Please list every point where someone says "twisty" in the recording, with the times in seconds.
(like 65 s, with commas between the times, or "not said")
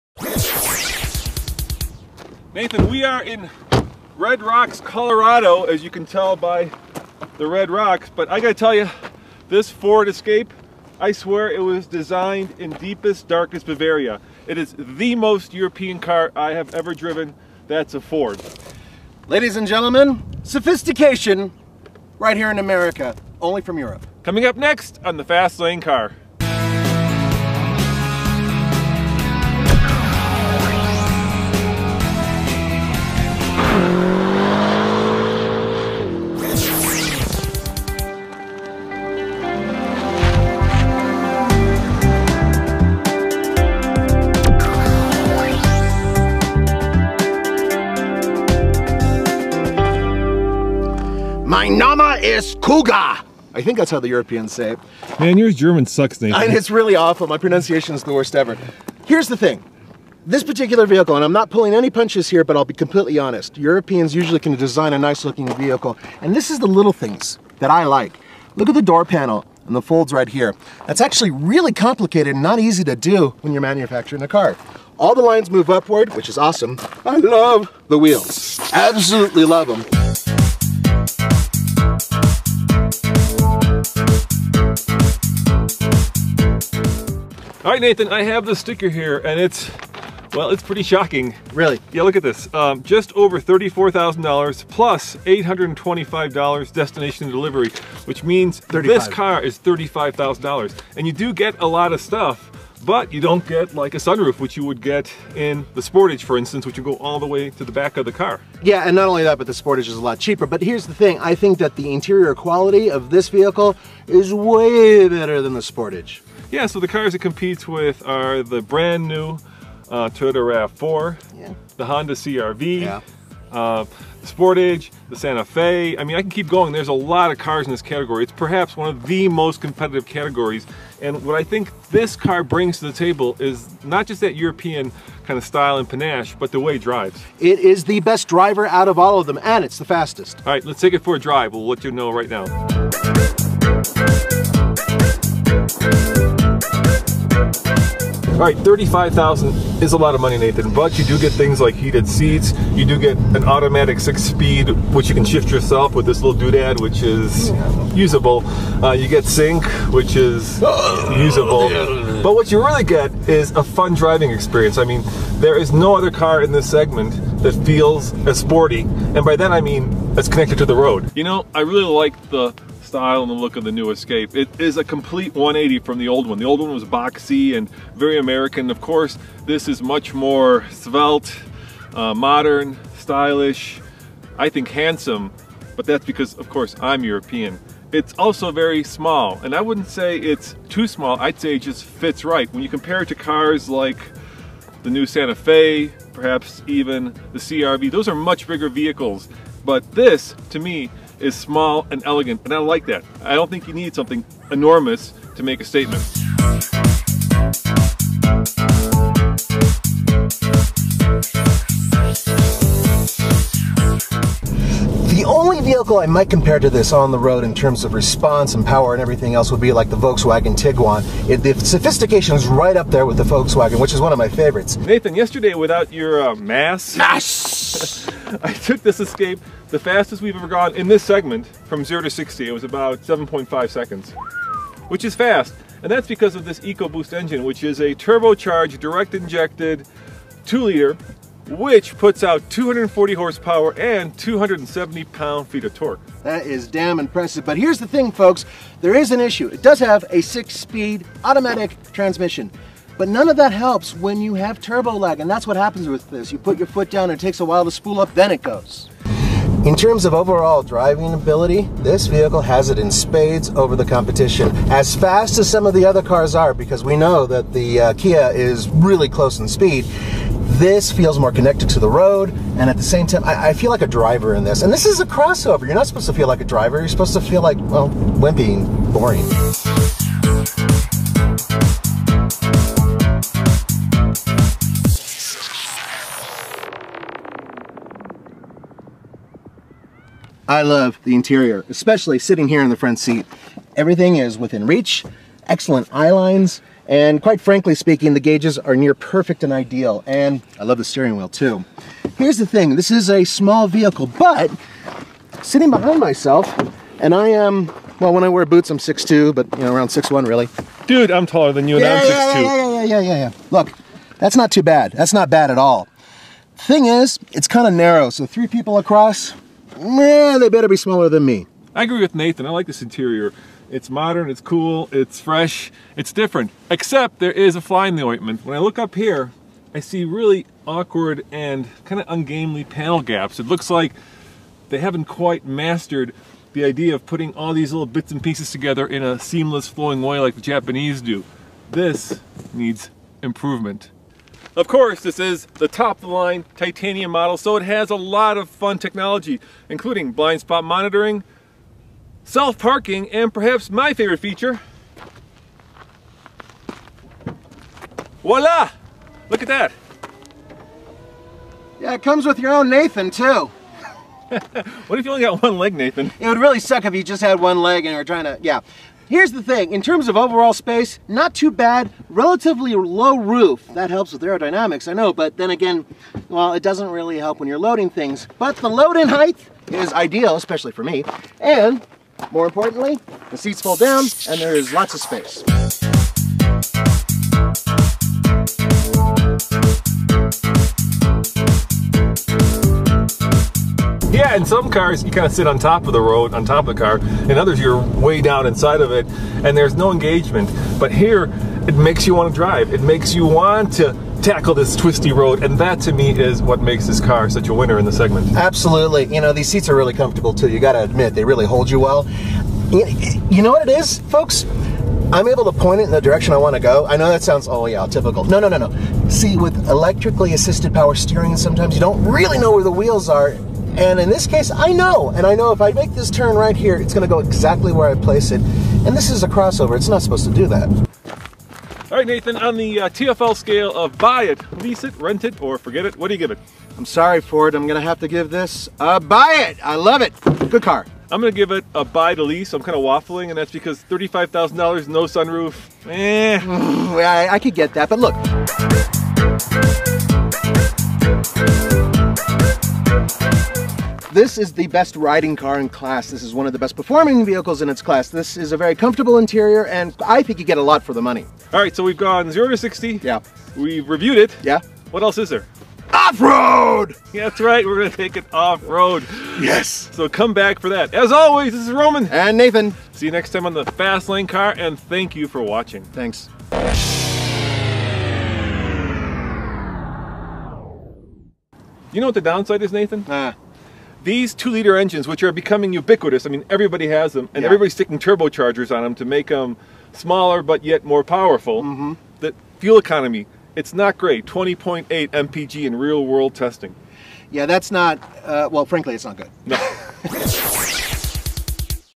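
404 s.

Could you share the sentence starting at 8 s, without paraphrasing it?
But I gotta tell you, this Ford Escape, I swear it was designed in deepest, darkest Bavaria.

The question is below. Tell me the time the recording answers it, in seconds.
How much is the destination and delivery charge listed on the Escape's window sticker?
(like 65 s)
95 s.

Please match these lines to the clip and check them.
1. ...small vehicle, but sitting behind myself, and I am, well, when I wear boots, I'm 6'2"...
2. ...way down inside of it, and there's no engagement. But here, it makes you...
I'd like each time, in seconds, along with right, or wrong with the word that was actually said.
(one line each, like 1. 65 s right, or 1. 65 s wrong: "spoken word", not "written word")
1. 303 s right
2. 397 s right.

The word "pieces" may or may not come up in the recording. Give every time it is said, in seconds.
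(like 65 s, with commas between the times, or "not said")
338 s.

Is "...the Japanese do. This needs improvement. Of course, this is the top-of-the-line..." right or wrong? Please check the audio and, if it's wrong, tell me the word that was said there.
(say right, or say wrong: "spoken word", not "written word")
right.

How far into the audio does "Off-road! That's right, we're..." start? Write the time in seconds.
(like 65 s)
465 s.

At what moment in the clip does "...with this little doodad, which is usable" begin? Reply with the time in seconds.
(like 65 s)
155 s.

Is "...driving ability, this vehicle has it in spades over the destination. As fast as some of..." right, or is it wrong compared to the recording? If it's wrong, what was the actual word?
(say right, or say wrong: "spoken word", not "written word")
wrong: "competition", not "destination".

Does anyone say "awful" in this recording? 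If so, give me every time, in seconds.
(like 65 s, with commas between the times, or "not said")
56 s.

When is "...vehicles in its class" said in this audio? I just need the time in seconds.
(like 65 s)
457 s.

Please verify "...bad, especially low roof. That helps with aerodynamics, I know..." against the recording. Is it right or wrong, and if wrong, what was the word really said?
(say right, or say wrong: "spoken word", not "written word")
wrong: "relatively", not "especially".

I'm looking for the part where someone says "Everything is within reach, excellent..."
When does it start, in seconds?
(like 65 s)
293 s.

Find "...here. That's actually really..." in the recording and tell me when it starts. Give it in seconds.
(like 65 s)
70 s.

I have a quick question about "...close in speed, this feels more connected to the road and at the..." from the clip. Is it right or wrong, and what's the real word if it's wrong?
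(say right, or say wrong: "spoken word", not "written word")
right.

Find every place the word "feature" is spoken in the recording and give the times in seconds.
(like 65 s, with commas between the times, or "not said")
354 s.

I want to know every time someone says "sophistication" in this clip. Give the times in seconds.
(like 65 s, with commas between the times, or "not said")
20 s, 221 s.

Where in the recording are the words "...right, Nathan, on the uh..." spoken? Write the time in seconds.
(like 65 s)
431 s.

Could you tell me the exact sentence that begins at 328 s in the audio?
When I look up here, I see really awkward and kind of ungainly panel gaps.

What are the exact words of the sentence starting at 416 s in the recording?
I know that sounds, oh yeah, typical.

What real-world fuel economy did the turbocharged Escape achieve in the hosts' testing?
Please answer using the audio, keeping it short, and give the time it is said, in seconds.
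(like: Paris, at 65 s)
20.8 mpg, at 494 s.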